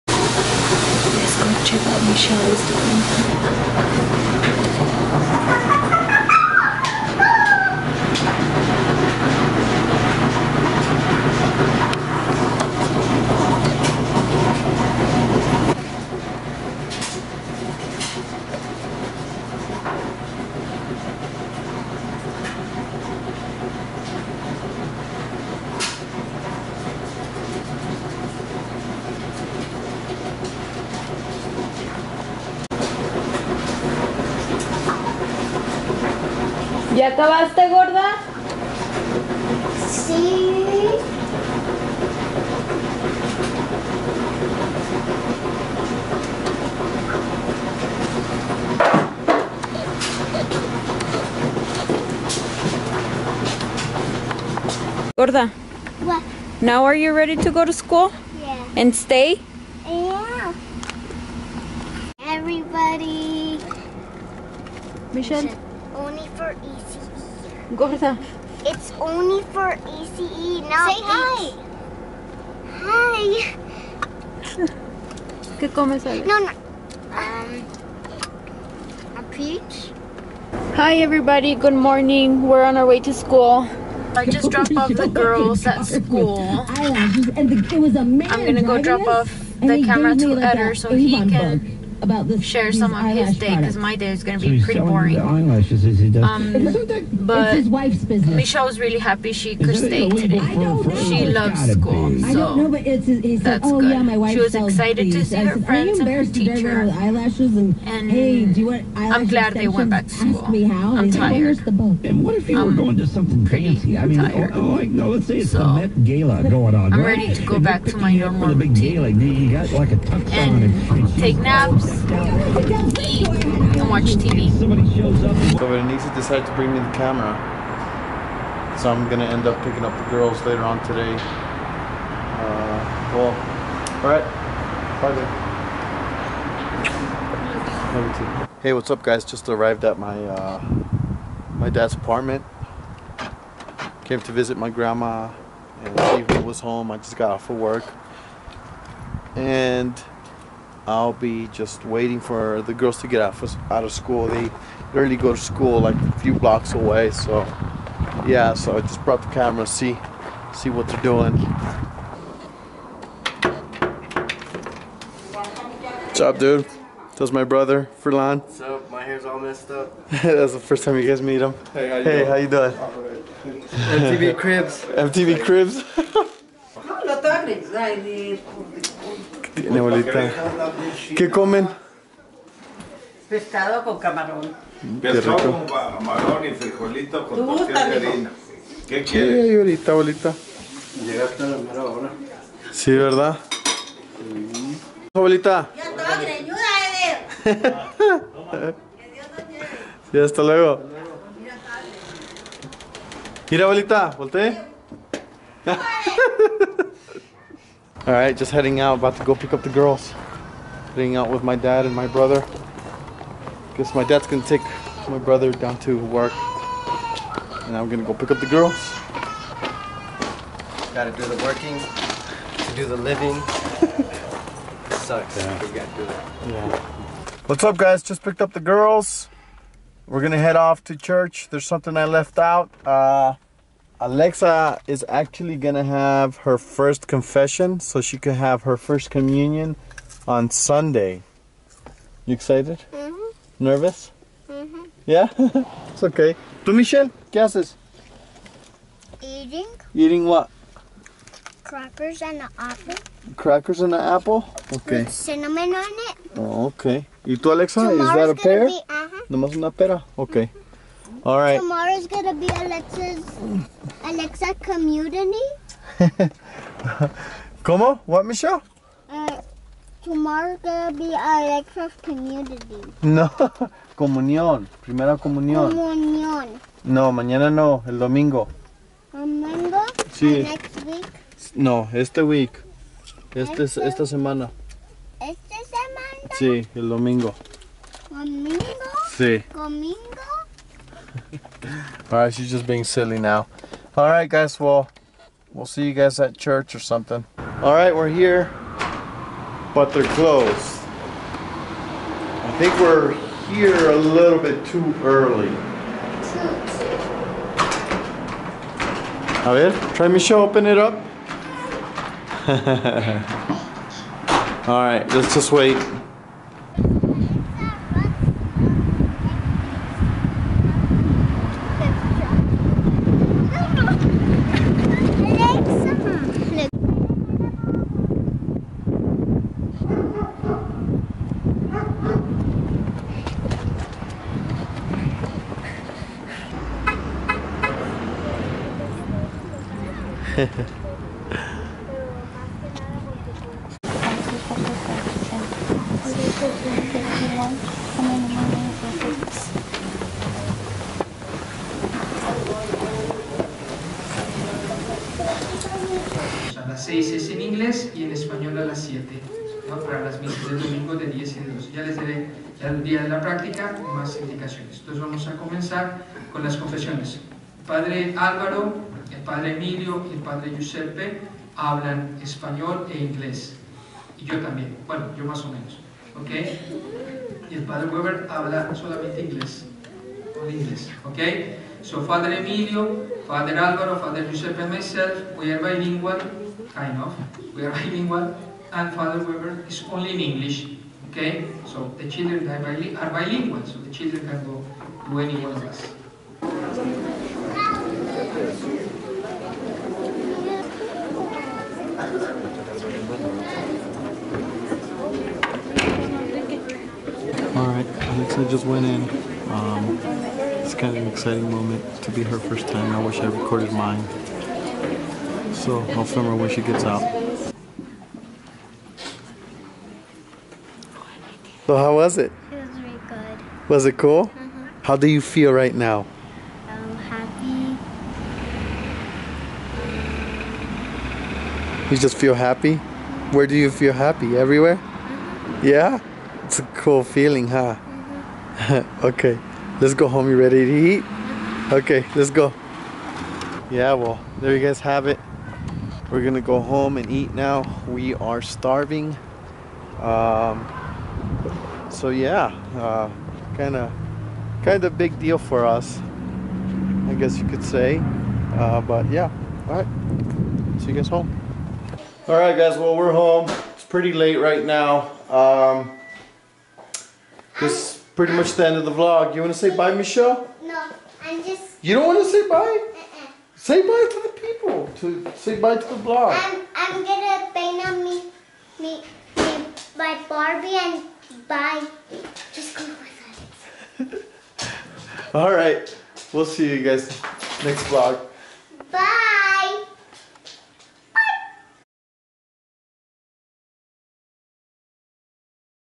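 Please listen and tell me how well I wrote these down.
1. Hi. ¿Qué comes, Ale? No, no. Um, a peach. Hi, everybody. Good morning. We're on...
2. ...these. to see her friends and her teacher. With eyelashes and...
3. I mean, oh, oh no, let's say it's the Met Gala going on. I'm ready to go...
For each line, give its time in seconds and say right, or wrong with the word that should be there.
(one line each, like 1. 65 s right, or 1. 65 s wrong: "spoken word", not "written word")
1. 72 s right
2. 105 s right
3. 113 s right.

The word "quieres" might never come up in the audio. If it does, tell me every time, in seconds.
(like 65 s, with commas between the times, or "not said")
189 s.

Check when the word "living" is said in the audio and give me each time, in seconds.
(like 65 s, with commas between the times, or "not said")
222 s.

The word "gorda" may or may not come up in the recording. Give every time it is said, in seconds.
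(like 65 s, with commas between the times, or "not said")
37 s, 55 s.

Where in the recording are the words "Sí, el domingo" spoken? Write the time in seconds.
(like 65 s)
286 s.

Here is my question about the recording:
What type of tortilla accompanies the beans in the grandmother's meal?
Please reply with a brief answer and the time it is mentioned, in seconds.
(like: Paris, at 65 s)
Harina, at 187 s.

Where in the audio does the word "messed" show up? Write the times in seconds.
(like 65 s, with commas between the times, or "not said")
169 s.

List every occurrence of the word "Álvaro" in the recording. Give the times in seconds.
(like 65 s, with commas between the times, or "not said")
368 s, 383 s.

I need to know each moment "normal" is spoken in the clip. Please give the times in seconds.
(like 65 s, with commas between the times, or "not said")
118 s.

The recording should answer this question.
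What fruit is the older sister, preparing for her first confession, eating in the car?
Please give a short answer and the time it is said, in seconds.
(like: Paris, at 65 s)
A pear, at 259 s.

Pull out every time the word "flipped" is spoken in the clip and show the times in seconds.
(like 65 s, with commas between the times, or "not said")
not said.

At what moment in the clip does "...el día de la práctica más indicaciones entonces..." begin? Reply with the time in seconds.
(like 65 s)
362 s.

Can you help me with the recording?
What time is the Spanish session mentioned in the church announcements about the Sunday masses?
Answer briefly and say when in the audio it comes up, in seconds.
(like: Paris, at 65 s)
7, at 358 s.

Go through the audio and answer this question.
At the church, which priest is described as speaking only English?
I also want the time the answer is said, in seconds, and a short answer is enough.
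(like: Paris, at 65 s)
Father Weber, at 388 s.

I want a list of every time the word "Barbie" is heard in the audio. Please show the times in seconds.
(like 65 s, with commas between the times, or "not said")
480 s.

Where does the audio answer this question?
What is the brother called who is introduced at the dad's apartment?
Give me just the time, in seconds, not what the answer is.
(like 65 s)
168 s.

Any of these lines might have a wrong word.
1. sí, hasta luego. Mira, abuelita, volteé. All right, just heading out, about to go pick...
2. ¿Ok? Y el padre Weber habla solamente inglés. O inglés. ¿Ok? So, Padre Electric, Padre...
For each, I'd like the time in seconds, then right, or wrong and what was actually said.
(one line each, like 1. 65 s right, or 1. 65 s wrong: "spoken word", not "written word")
1. 200 s right
2. 376 s wrong: "Emilio", not "Electric".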